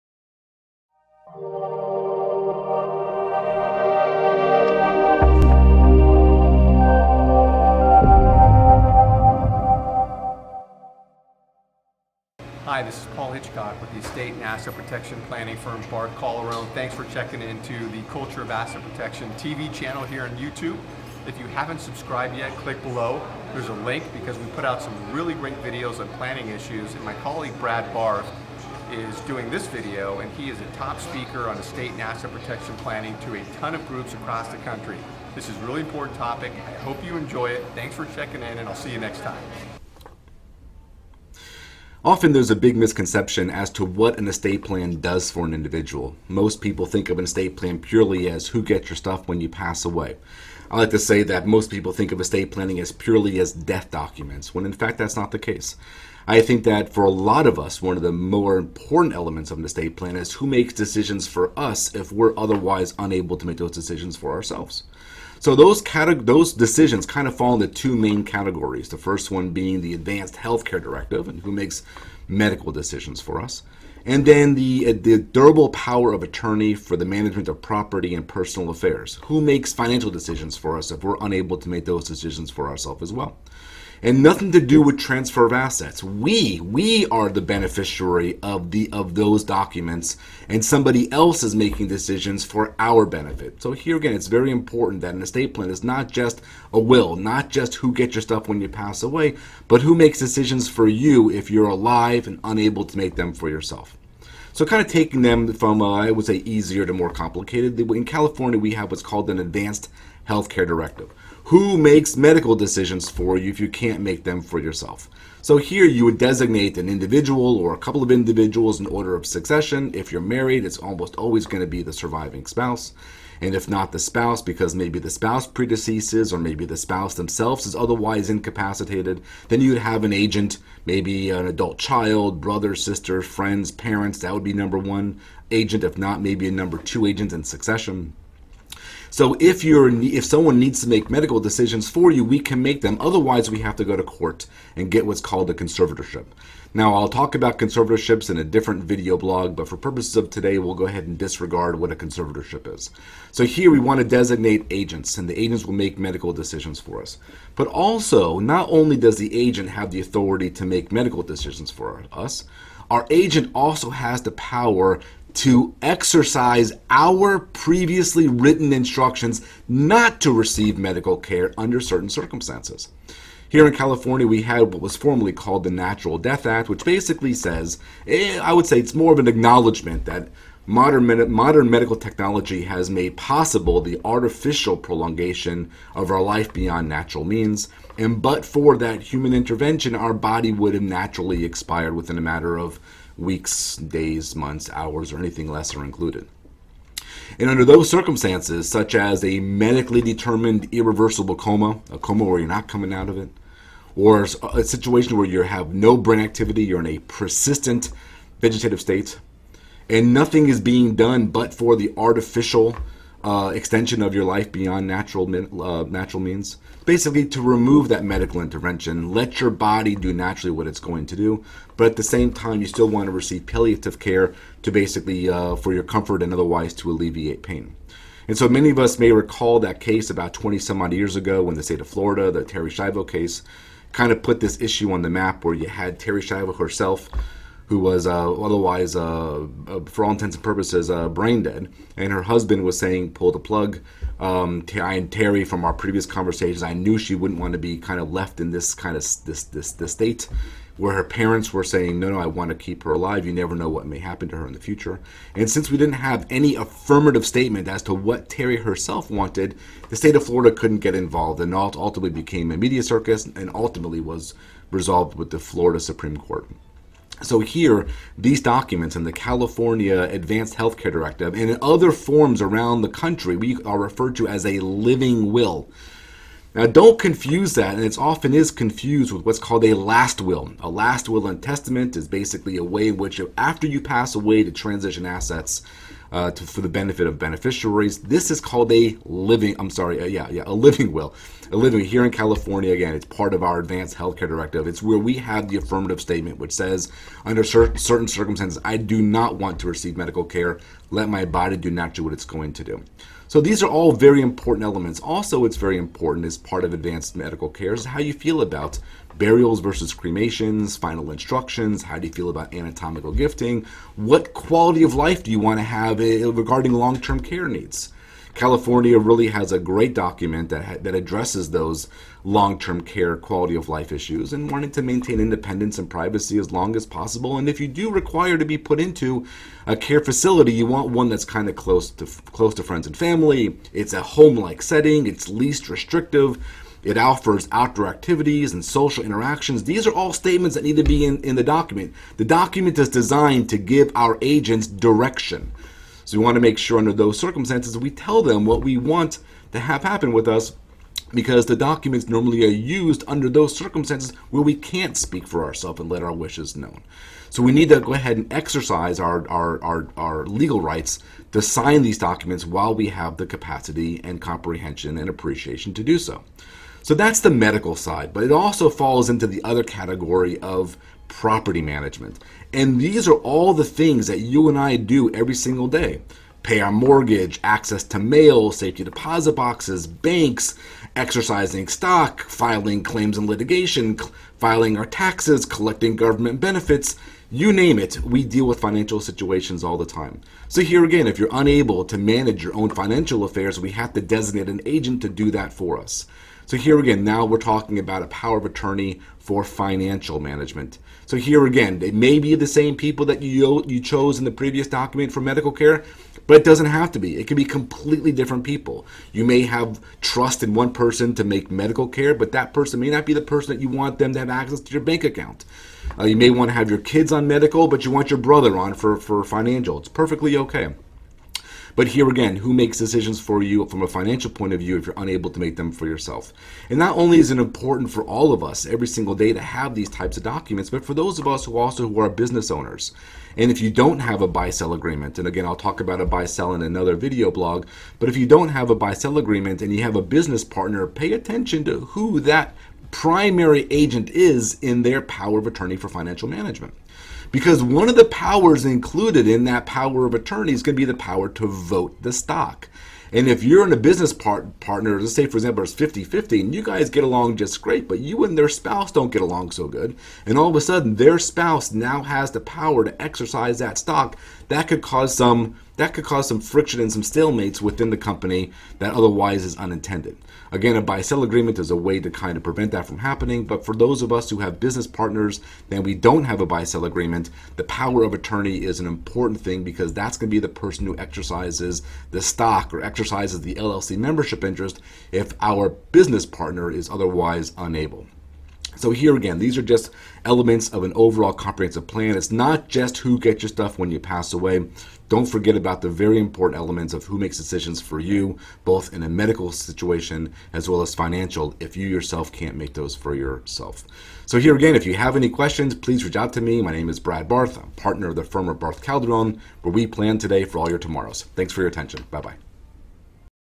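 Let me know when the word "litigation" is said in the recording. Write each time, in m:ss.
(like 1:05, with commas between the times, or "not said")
6:23.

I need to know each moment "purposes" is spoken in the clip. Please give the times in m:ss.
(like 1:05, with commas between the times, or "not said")
2:29, 4:00.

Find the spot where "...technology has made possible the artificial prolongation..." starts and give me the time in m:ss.
3:01.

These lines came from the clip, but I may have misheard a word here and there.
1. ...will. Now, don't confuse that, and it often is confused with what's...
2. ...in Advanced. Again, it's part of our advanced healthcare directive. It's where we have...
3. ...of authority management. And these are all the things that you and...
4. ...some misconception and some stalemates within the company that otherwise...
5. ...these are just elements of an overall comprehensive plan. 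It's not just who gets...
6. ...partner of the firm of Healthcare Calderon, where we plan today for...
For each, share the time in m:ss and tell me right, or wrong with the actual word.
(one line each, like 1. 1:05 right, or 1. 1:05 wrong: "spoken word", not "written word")
1. 4:35 right
2. 4:52 wrong: "California", not "Advanced"
3. 6:10 wrong: "property", not "authority"
4. 7:46 wrong: "friction", not "misconception"
5. 8:09 right
6. 8:27 wrong: "Barth", not "Healthcare".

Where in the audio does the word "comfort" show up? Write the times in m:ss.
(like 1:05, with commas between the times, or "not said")
3:45.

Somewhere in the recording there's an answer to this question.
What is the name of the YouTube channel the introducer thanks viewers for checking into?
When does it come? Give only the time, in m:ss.
0:18.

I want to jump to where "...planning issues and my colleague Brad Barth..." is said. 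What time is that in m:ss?
0:26.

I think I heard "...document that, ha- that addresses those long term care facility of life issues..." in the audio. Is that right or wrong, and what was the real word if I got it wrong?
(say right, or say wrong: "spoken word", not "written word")
wrong: "quality", not "facility".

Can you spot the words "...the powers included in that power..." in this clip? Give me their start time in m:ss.
7:27.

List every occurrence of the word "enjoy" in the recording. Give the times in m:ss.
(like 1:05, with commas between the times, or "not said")
0:37.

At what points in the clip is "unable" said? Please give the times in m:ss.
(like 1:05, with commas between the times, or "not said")
1:02, 1:21, 1:42, 6:31, 7:04, 8:07.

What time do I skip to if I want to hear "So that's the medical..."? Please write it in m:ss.
6:06.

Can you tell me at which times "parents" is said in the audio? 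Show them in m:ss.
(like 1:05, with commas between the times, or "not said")
2:13, 4:11.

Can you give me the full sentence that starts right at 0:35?
This is a really important topic.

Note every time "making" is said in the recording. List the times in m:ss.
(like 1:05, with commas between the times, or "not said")
1:31.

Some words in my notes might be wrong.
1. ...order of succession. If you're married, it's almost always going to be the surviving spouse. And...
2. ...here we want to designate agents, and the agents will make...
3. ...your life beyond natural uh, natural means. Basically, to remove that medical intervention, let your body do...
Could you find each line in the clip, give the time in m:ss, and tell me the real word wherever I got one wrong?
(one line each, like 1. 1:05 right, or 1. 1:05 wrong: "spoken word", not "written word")
1. 1:58 right
2. 2:33 right
3. 3:34 right.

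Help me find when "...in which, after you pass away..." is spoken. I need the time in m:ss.
4:42.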